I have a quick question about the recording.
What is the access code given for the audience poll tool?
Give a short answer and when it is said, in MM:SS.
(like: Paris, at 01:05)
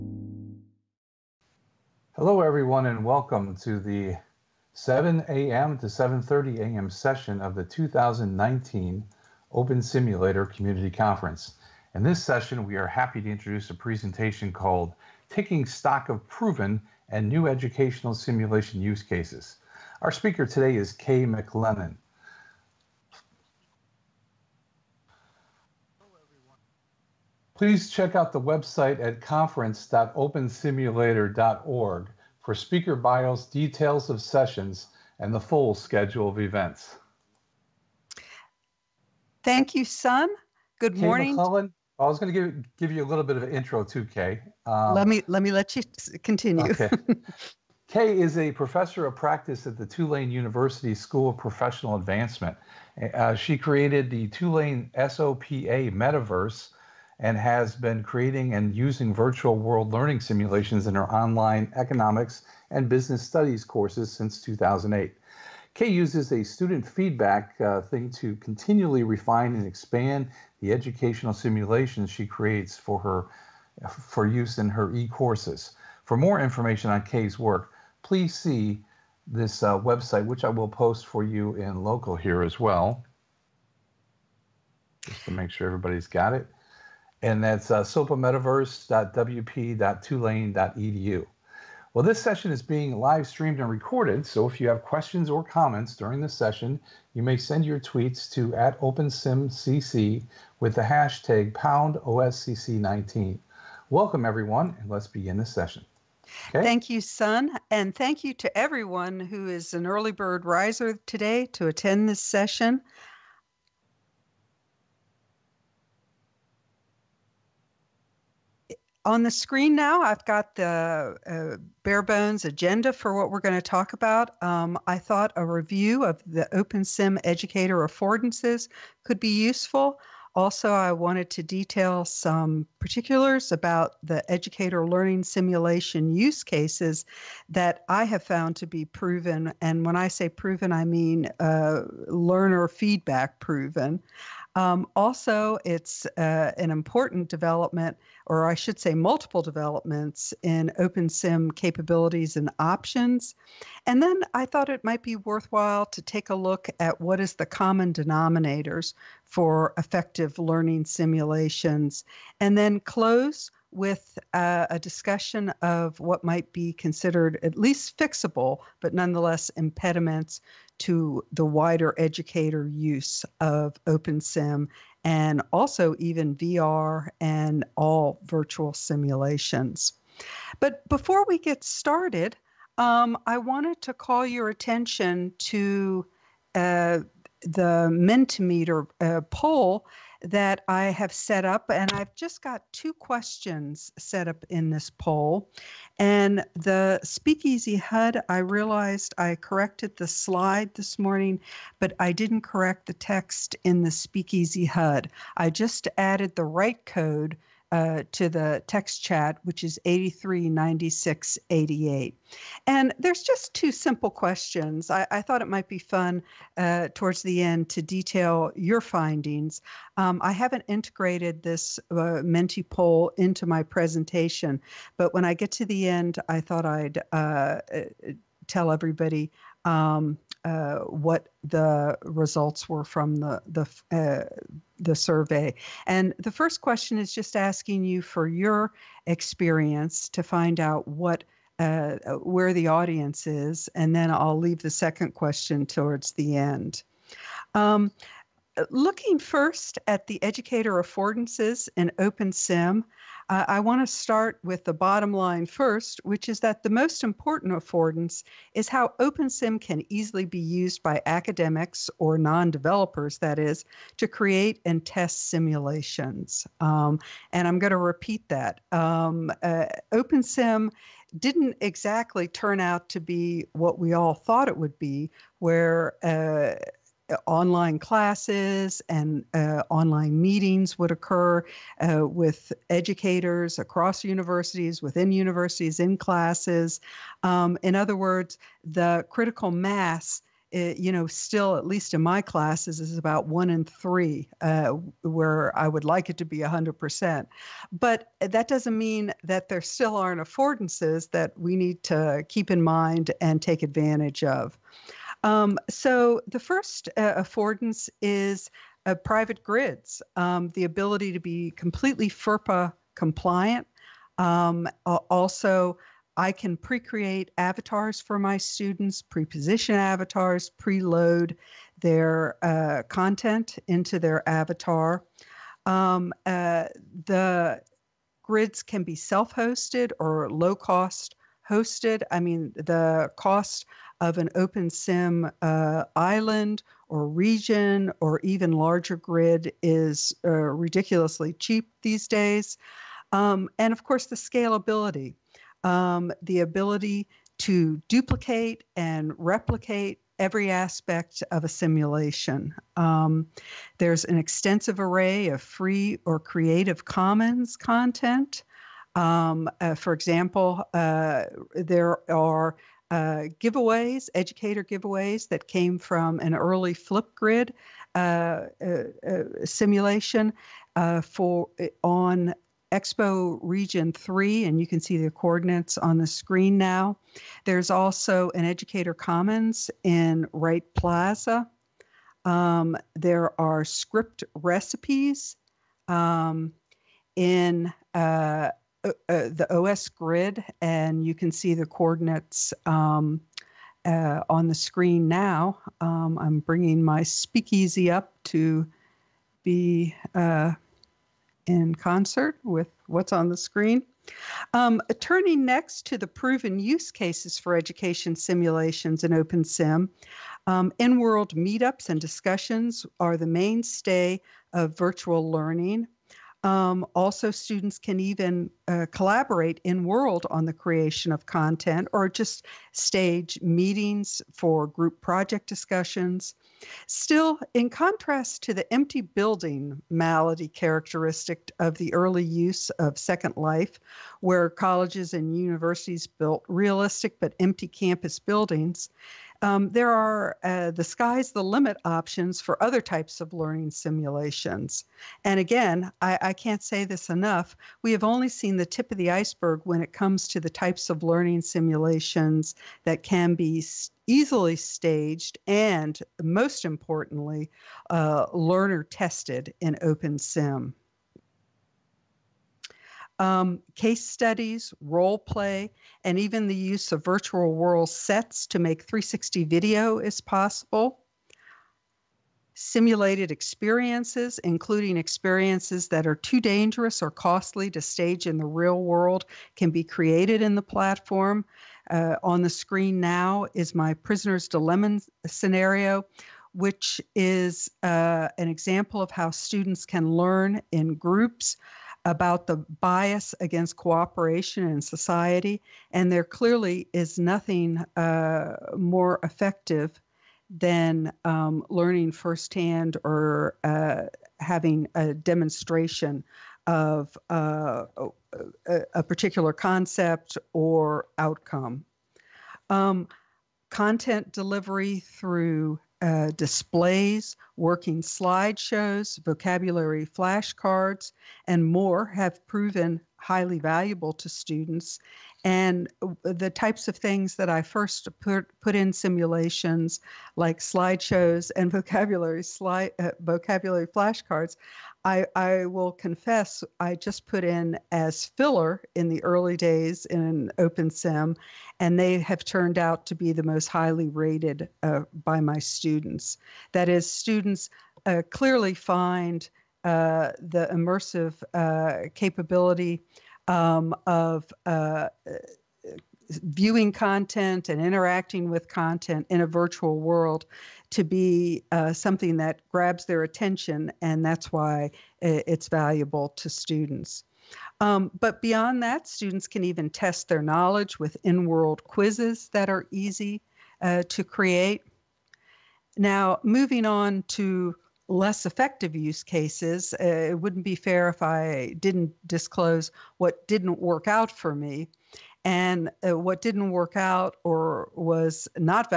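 839688, at 03:29.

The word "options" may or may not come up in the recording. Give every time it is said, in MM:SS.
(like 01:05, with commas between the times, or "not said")
02:32, 07:21.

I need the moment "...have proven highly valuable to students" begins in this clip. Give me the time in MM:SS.
08:42.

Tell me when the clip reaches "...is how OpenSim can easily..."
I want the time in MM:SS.
04:18.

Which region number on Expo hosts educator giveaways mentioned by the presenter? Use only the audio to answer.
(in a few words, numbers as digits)
3.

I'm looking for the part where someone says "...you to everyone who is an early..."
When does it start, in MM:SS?
01:48.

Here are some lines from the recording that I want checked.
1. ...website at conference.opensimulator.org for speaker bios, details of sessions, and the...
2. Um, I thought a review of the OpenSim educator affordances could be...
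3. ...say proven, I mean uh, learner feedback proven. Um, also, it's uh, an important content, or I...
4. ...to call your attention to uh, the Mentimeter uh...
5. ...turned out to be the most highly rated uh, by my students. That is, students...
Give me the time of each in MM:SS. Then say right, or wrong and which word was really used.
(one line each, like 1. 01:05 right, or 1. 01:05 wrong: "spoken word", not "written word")
1. 00:28 right
2. 02:04 right
3. 02:20 wrong: "development", not "content"
4. 03:03 right
5. 09:02 right.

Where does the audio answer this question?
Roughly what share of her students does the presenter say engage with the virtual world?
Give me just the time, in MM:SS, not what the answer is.
04:53.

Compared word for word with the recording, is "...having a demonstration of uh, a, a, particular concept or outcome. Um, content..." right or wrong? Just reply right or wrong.
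right.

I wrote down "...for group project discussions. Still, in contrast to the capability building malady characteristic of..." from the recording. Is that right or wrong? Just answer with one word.
wrong.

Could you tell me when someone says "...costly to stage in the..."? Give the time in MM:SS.
07:57.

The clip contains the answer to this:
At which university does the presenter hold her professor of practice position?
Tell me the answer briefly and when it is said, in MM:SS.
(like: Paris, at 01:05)
Tulane University, at 00:49.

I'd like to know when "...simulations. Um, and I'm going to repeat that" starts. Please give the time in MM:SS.
04:25.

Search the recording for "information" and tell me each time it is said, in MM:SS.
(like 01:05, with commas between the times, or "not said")
01:16.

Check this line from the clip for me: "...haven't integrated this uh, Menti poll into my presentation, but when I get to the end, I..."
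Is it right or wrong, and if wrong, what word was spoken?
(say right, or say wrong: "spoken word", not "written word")
right.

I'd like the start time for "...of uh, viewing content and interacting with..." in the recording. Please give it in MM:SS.
09:14.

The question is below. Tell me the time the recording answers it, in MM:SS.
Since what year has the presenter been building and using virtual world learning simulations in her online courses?
01:04.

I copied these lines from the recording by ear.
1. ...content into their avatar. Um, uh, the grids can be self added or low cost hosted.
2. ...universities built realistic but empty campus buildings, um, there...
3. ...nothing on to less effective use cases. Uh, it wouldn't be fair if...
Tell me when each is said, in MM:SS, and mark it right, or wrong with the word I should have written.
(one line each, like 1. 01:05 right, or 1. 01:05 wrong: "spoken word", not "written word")
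1. 05:22 wrong: "hosted", not "added"
2. 07:15 right
3. 09:36 wrong: "moving", not "nothing".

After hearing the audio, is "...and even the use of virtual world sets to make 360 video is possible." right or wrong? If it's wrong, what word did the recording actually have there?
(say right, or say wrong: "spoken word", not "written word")
right.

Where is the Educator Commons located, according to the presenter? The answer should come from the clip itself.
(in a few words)
Wright Plaza.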